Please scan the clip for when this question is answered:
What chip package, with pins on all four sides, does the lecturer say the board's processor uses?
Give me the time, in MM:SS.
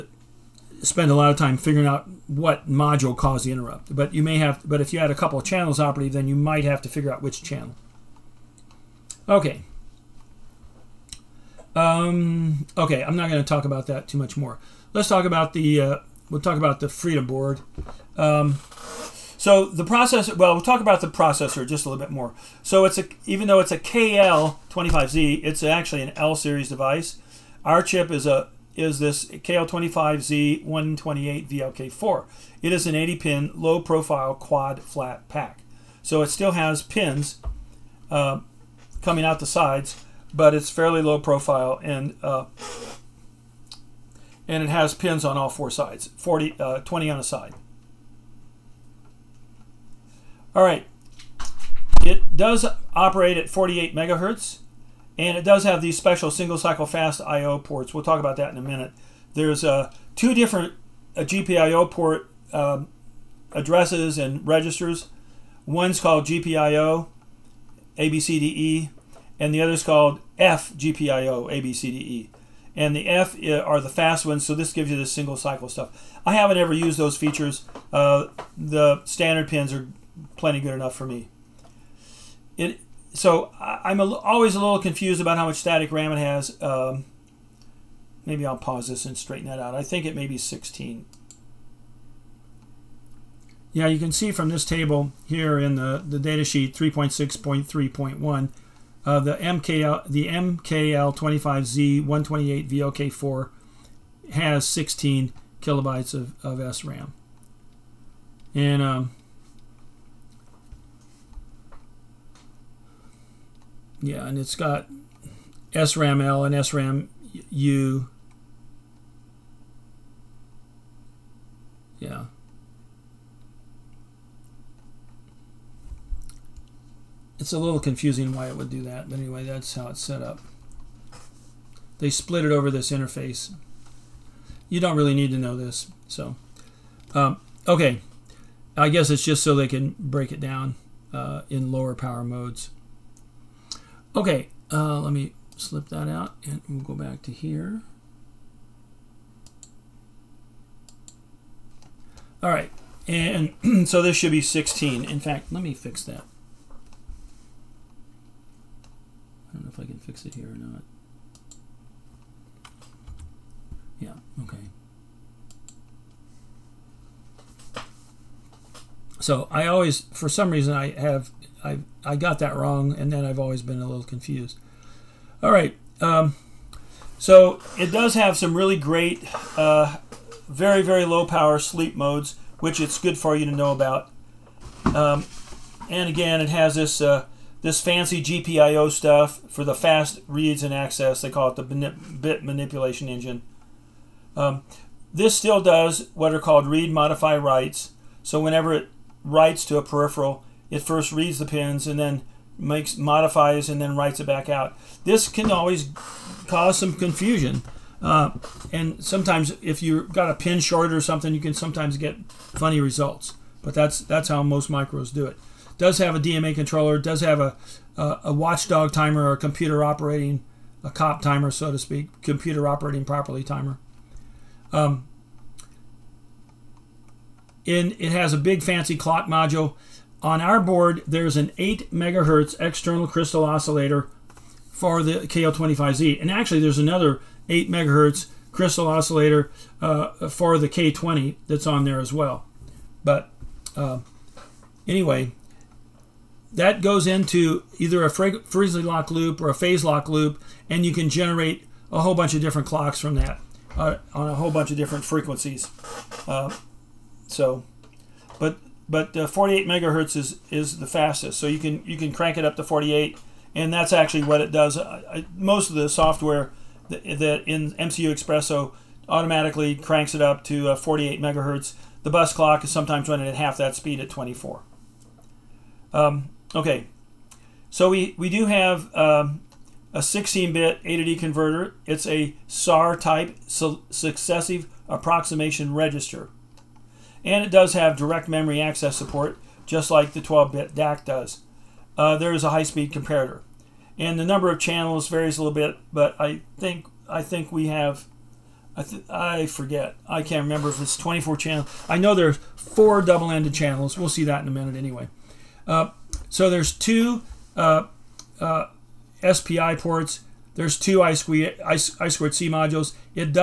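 00:32.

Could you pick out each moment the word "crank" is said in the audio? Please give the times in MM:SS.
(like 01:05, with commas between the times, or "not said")
04:22, 04:29.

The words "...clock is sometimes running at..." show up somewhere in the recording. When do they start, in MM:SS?
04:32.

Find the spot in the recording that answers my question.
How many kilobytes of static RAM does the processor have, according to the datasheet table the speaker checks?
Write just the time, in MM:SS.
01:44.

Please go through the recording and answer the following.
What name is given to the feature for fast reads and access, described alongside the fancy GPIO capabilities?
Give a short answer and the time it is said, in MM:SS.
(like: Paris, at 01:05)
bit manipulation engine, at 03:11.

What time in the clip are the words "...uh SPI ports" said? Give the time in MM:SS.
05:08.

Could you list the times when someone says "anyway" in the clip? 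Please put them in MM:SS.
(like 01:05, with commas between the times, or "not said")
02:09, 04:04, 05:04.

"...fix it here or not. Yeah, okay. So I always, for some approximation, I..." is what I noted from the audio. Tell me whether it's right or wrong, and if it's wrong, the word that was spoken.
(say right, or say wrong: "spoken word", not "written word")
wrong: "reason", not "approximation".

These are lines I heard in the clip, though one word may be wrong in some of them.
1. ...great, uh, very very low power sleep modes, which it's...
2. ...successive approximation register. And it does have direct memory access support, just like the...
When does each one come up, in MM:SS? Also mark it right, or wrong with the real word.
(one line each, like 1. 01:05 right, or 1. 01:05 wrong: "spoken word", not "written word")
1. 02:58 right
2. 04:43 right.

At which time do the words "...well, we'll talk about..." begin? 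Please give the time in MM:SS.
00:20.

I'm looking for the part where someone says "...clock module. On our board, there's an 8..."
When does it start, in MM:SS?
03:48.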